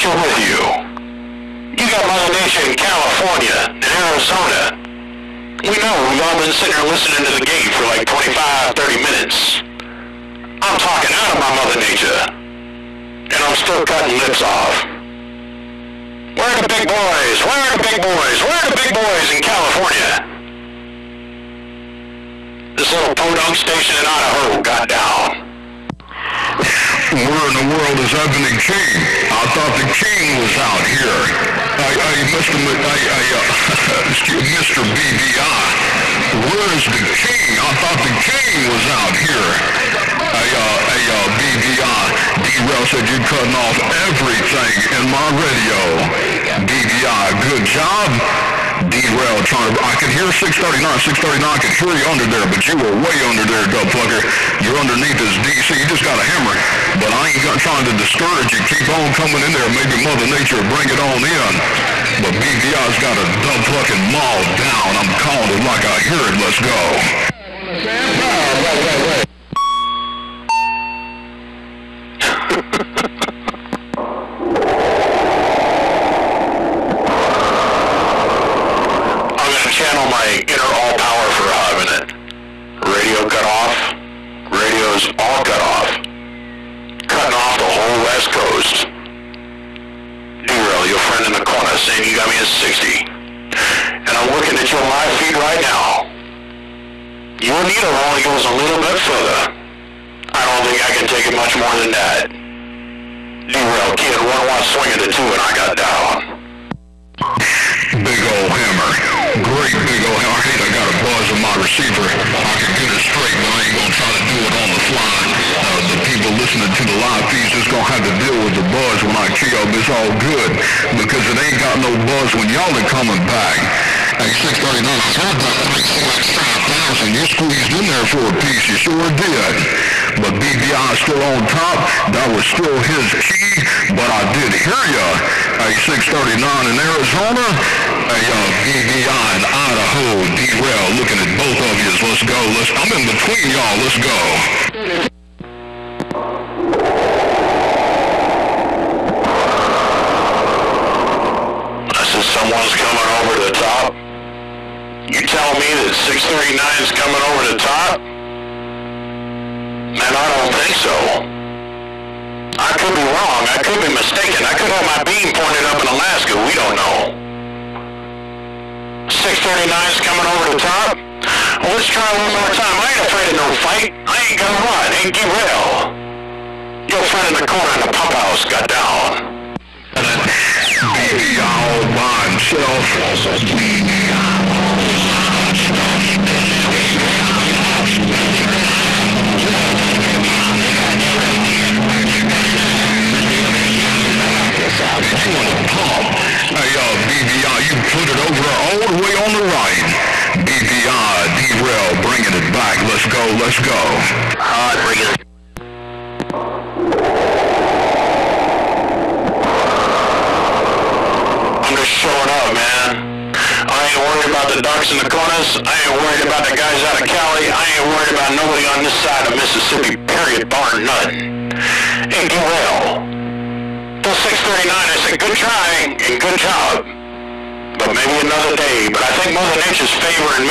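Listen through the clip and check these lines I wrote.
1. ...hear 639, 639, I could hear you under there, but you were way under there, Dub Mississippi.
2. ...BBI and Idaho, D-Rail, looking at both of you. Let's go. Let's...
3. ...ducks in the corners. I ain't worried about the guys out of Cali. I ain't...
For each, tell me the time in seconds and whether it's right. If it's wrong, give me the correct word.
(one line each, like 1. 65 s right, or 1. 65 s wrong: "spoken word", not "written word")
1. 50 s wrong: "Plucker", not "Mississippi"
2. 138 s right
3. 214 s right.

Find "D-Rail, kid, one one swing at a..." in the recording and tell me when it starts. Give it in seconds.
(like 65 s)
103 s.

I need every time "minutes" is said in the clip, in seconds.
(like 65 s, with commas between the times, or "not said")
9 s, 81 s.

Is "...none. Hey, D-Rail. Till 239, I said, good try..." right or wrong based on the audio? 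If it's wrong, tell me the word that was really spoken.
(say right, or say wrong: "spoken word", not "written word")
wrong: "639", not "239".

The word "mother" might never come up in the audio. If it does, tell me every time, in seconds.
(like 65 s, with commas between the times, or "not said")
2 s, 11 s, 60 s, 229 s.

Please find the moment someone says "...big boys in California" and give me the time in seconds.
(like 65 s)
18 s.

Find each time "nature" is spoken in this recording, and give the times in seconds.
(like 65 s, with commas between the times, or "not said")
2 s, 11 s, 60 s, 229 s.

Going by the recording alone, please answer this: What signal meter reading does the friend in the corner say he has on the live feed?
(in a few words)
60.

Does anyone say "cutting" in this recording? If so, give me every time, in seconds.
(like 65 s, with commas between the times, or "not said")
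13 s, 43 s, 87 s.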